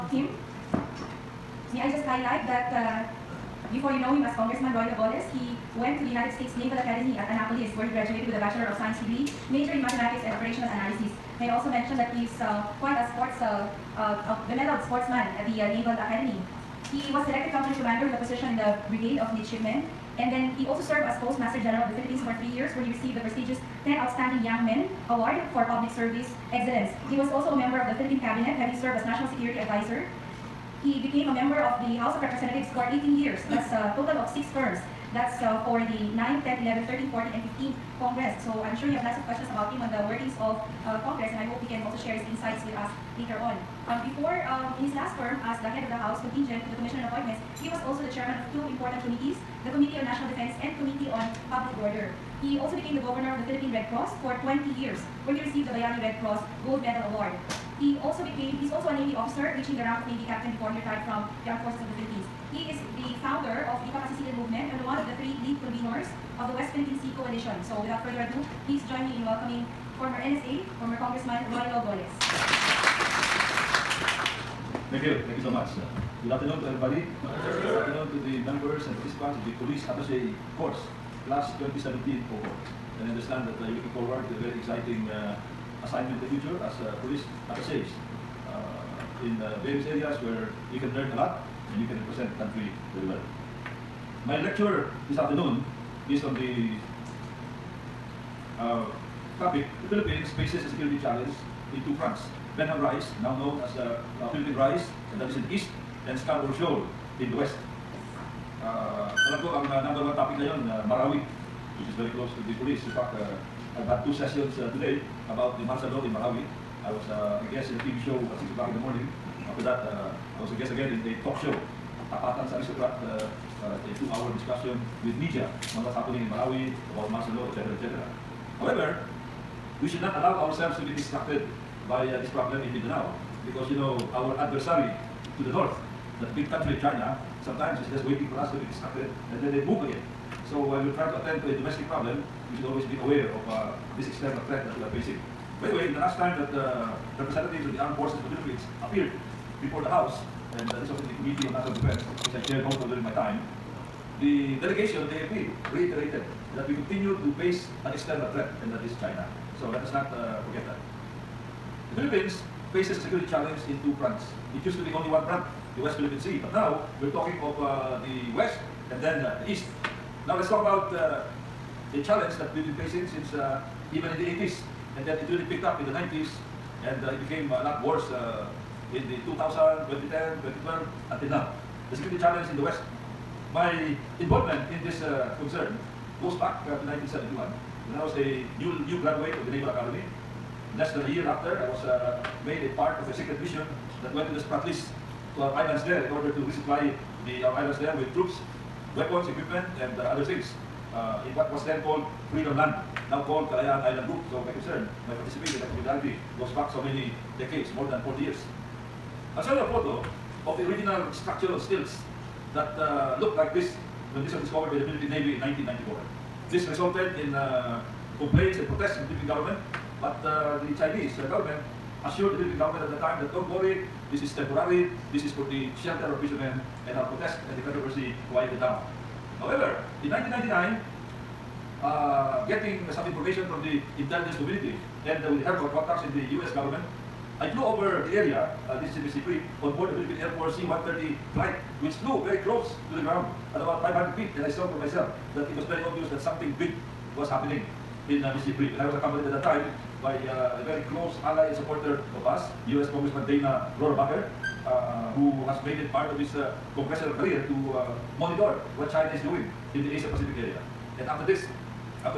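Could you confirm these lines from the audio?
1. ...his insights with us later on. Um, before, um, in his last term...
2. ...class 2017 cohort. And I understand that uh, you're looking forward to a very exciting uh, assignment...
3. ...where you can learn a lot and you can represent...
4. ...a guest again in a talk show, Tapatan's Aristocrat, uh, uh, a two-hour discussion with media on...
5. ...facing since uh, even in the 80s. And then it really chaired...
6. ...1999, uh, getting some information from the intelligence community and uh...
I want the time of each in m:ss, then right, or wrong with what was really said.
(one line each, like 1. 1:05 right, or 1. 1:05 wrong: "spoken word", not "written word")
1. 0:42 right
2. 1:21 right
3. 1:30 right
4. 2:00 right
5. 2:52 wrong: "picked", not "chaired"
6. 3:50 right.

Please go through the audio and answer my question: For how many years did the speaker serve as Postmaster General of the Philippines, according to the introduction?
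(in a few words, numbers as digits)
3.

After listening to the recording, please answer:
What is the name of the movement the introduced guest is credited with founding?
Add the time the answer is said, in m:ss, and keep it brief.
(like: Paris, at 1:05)
Kapasisigan Movement, at 1:03.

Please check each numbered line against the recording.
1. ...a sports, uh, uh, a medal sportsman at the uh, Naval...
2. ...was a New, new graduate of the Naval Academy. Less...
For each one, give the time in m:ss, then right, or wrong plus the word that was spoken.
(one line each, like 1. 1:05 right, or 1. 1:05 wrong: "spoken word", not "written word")
1. 0:12 right
2. 3:08 right.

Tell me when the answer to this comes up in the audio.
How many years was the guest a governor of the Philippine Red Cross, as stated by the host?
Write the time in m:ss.
0:54.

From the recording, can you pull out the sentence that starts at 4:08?
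And I was accompanied at that time by uh, a very close ally and supporter of us, U.S.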